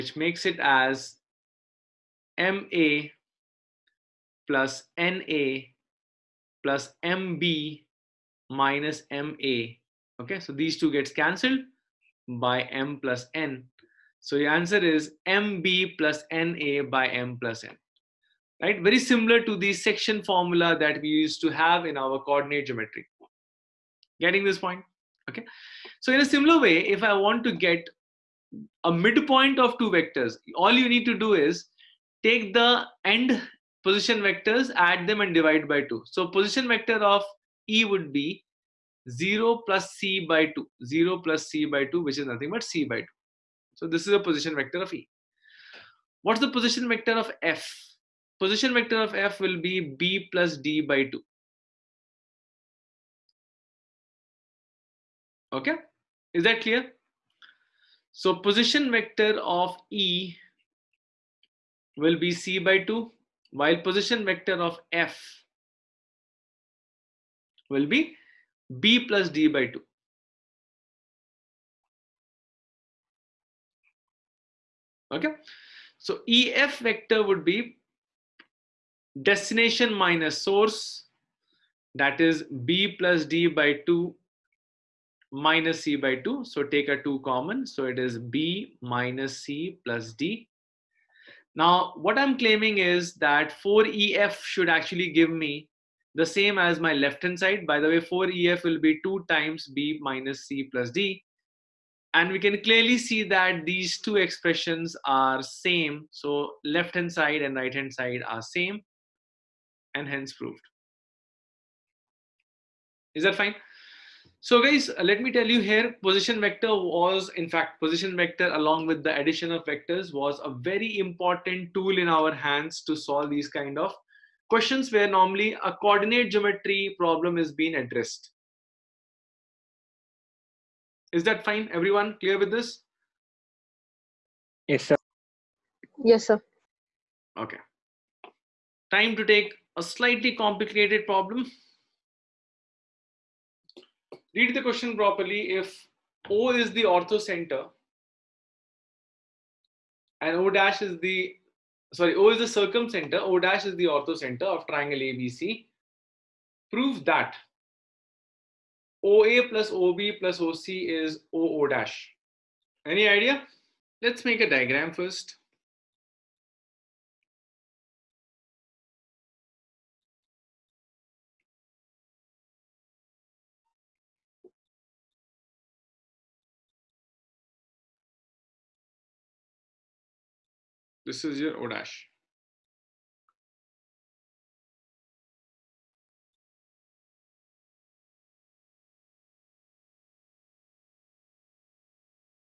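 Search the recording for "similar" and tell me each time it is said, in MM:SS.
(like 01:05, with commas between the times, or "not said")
00:18, 00:26.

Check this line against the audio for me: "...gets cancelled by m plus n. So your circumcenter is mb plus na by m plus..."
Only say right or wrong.
wrong.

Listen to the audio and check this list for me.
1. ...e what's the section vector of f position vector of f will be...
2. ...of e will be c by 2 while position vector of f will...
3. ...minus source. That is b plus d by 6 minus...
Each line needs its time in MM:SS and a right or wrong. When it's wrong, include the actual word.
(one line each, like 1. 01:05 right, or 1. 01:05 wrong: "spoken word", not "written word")
1. 00:44 wrong: "position", not "section"
2. 00:59 right
3. 01:19 wrong: "2", not "6".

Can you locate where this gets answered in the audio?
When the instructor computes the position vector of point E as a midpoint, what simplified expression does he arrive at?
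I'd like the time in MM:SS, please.
00:41.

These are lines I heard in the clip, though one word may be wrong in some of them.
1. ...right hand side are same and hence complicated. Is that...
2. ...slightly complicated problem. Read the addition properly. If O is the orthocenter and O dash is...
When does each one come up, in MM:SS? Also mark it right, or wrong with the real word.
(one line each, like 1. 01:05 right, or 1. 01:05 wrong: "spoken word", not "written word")
1. 01:47 wrong: "proved", not "complicated"
2. 02:19 wrong: "question", not "addition".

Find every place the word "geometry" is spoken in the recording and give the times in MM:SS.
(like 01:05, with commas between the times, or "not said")
00:22, 02:06.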